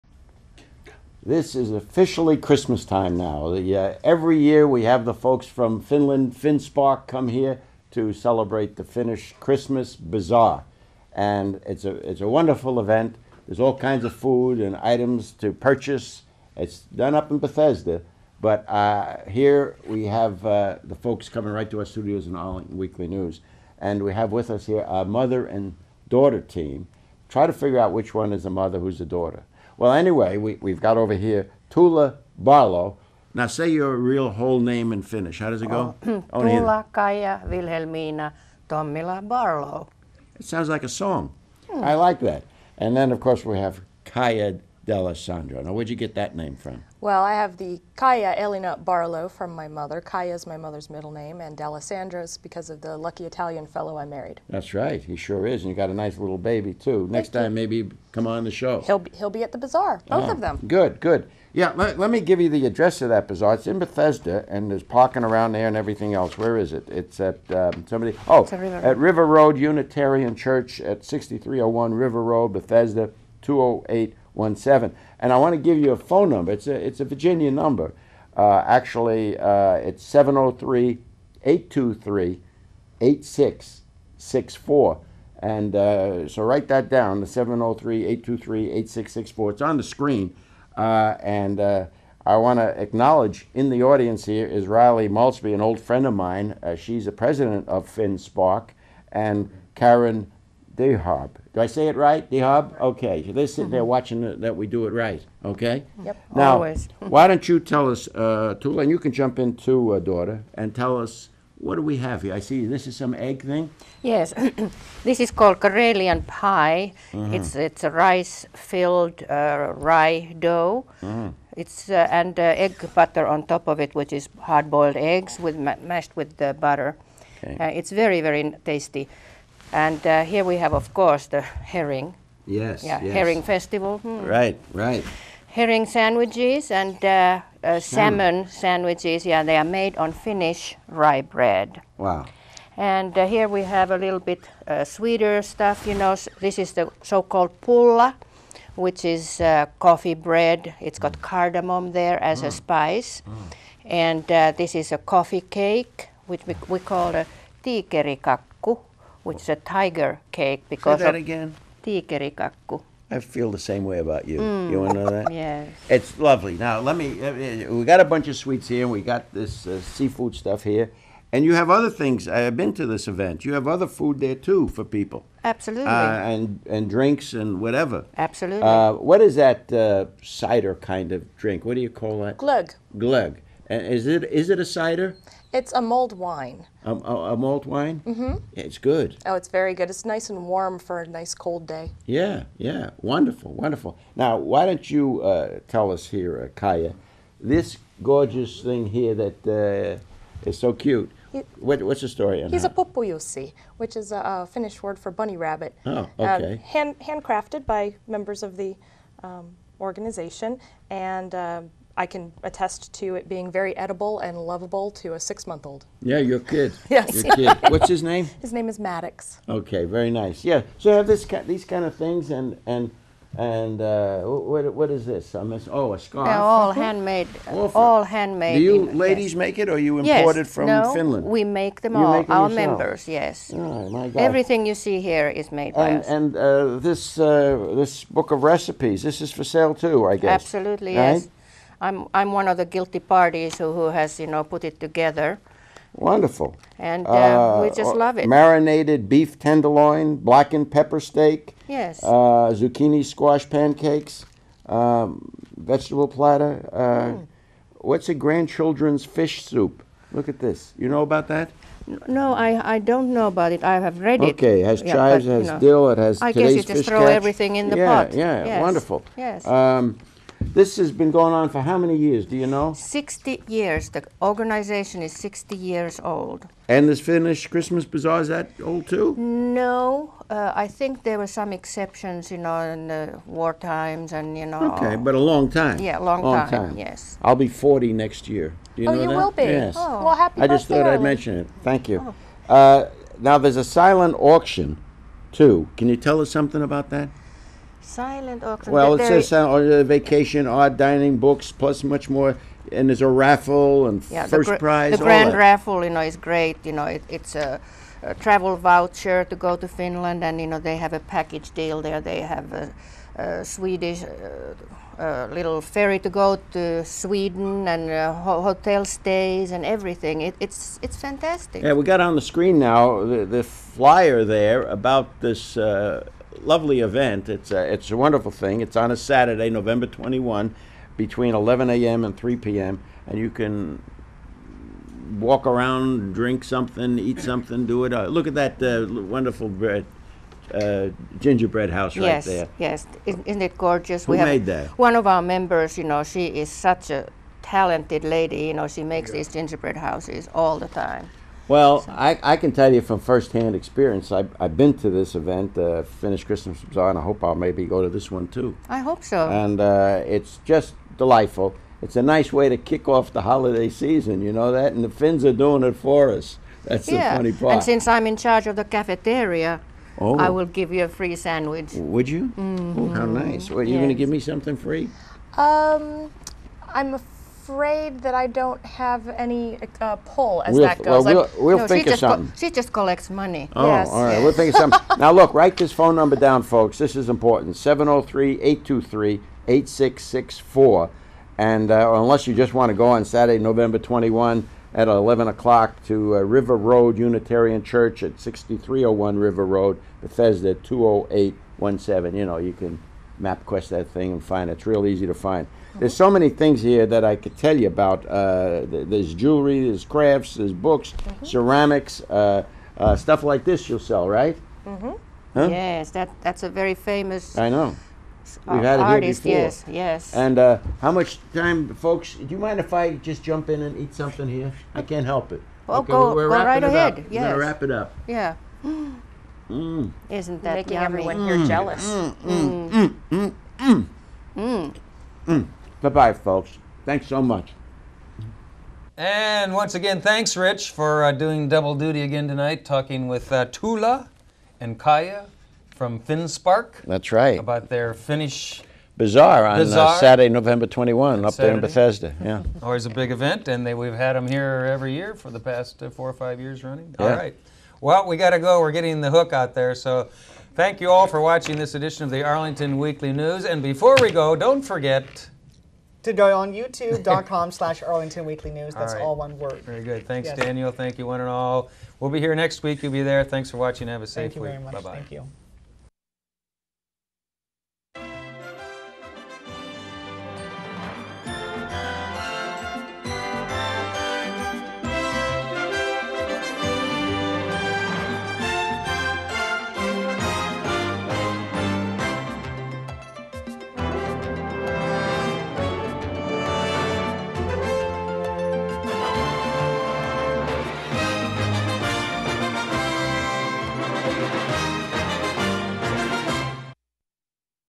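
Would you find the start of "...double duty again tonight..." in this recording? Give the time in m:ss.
7:21.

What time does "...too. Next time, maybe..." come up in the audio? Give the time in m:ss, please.
0:56.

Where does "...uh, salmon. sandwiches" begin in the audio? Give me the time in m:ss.
2:17.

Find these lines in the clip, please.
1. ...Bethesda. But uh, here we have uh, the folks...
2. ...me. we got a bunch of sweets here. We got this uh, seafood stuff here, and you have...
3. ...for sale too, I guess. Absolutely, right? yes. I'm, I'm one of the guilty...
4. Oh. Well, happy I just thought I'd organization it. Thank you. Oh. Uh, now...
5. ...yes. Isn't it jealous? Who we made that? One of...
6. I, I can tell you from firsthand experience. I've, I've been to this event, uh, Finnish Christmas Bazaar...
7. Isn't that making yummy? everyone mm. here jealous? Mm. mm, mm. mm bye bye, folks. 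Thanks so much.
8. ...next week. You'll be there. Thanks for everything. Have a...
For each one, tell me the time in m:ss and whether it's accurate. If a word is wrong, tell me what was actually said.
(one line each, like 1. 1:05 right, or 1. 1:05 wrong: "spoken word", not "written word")
1. 0:17 right
2. 2:46 right
3. 3:59 right
4. 4:49 wrong: "mention", not "organization"
5. 5:43 wrong: "gorgeous", not "jealous"
6. 5:51 right
7. 7:10 right
8. 7:52 wrong: "watching", not "everything".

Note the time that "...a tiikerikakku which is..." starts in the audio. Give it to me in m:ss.
2:37.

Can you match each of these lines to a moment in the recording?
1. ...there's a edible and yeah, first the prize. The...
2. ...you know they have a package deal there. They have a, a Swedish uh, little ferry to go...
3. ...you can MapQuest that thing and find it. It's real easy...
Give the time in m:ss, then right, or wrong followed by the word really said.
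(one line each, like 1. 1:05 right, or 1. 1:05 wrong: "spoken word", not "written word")
1. 5:02 wrong: "raffle", not "edible"
2. 5:10 right
3. 6:42 right.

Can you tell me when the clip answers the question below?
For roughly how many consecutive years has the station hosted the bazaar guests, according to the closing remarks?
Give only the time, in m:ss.
7:35.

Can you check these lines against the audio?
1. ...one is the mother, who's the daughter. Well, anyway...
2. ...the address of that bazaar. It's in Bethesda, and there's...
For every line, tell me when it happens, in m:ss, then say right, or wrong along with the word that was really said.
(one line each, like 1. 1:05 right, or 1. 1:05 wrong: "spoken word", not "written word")
1. 0:28 right
2. 1:02 right.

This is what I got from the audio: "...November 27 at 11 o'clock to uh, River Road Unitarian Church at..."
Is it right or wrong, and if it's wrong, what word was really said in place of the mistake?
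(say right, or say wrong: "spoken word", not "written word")
wrong: "21", not "27".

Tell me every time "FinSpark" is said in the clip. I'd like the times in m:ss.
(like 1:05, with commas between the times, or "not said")
0:06, 1:37, 7:25.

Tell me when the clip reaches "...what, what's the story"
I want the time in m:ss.
3:21.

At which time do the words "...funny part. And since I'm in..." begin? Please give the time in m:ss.
6:07.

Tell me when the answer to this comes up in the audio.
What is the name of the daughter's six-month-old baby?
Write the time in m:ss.
3:38.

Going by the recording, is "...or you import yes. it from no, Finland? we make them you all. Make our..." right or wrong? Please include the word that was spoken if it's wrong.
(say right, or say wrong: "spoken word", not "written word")
right.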